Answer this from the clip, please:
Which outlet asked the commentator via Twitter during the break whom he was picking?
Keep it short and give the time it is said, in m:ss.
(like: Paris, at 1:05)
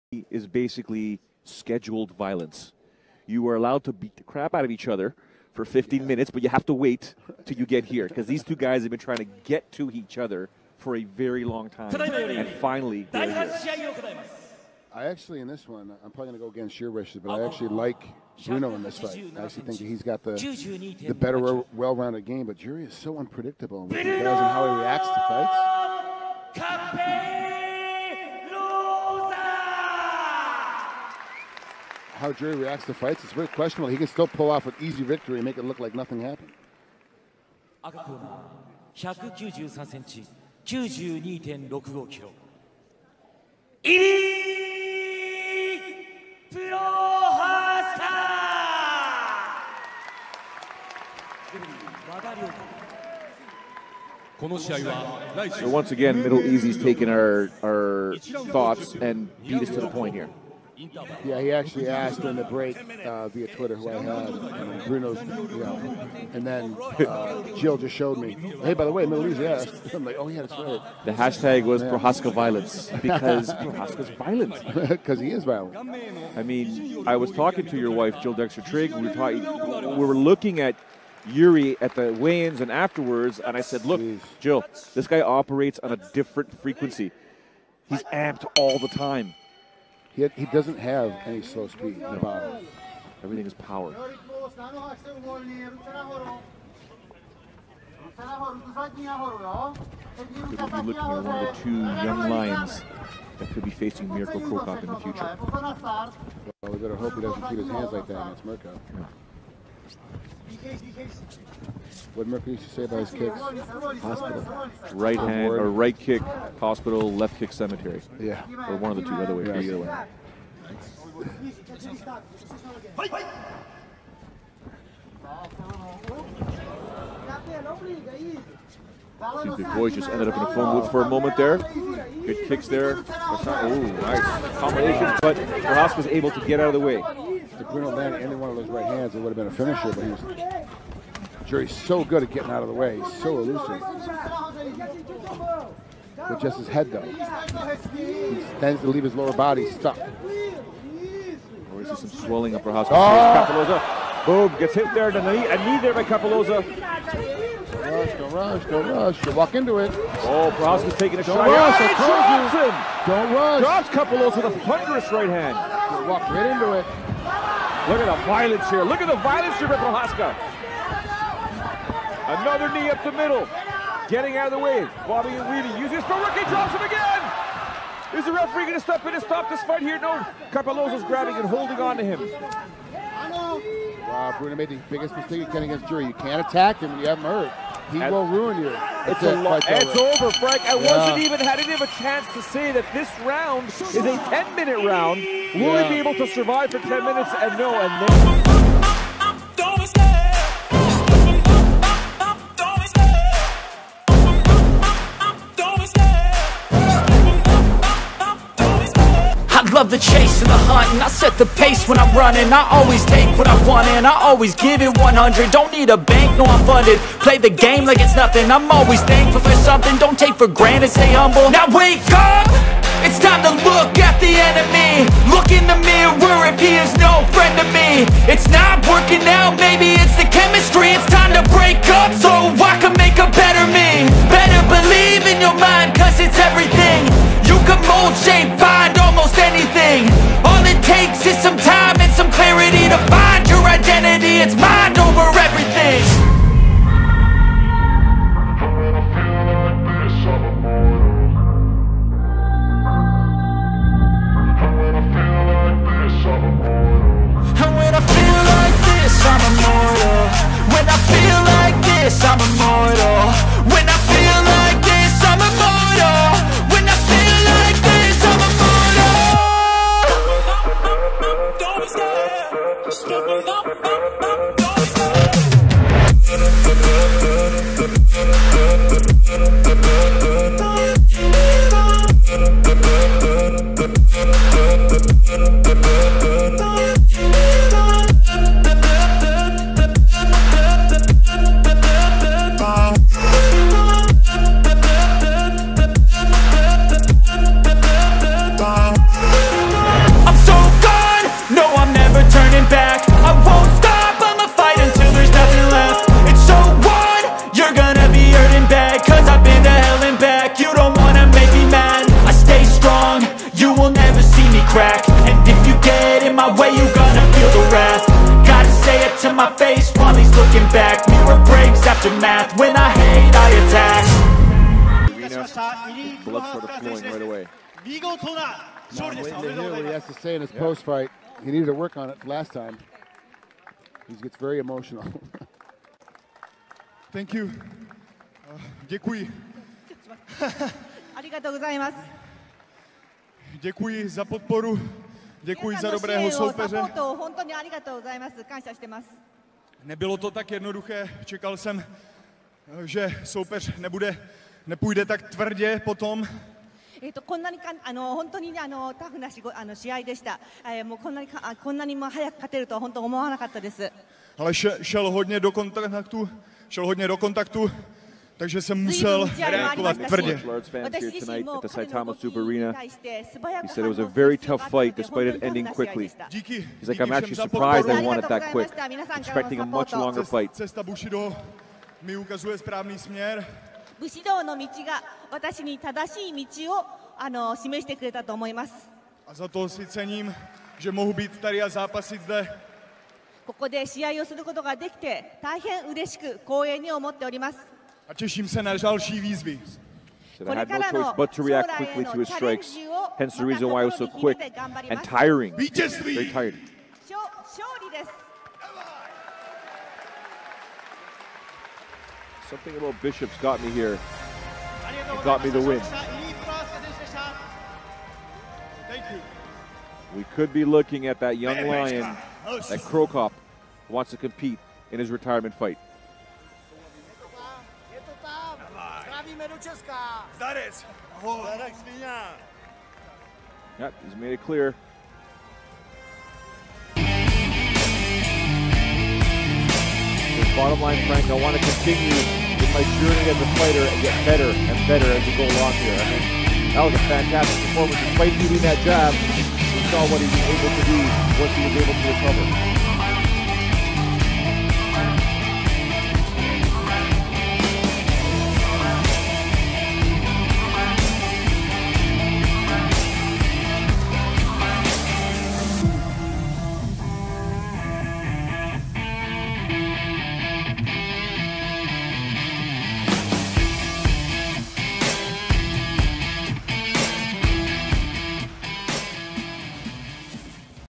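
MiddleEasy, at 1:09.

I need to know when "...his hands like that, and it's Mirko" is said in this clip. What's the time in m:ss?
1:47.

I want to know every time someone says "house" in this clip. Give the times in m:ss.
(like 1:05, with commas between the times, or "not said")
2:32.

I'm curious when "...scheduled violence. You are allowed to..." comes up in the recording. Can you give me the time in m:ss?
0:01.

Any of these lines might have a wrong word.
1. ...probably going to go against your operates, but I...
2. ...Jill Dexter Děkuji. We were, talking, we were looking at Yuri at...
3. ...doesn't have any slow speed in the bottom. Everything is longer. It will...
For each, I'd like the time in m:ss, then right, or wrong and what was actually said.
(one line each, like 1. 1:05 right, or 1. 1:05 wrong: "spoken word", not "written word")
1. 0:16 wrong: "wishes", not "operates"
2. 1:18 wrong: "Trigg", not "Děkuji"
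3. 1:30 wrong: "power", not "longer".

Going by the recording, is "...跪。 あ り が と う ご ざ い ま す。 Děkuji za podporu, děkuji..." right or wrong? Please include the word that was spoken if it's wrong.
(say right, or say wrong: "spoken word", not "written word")
right.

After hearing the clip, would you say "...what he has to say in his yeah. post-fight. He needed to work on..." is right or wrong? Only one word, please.
right.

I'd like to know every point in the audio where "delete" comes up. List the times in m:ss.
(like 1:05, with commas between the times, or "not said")
not said.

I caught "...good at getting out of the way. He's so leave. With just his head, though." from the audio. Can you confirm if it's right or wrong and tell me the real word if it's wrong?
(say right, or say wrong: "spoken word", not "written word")
wrong: "elusive", not "leave".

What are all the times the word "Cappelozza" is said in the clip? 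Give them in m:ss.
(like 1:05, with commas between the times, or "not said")
2:36, 2:43, 3:00.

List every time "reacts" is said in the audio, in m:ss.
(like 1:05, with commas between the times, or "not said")
0:24, 0:32, 6:41.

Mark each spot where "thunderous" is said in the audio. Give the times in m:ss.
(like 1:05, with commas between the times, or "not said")
2:44.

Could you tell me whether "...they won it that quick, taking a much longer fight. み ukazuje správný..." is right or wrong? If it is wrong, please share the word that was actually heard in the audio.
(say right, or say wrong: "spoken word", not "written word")
wrong: "expecting", not "taking".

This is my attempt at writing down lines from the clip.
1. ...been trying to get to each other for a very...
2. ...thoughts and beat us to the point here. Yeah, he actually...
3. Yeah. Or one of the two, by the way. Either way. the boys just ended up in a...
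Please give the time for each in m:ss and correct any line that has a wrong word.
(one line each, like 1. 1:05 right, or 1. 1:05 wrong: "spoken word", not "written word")
1. 0:08 right
2. 0:58 right
3. 1:58 right.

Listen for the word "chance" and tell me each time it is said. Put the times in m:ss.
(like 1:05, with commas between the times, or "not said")
3:11.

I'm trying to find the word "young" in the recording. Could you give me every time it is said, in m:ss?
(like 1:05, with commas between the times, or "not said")
1:41, 7:01.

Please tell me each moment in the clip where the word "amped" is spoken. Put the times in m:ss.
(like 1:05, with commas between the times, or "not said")
1:28.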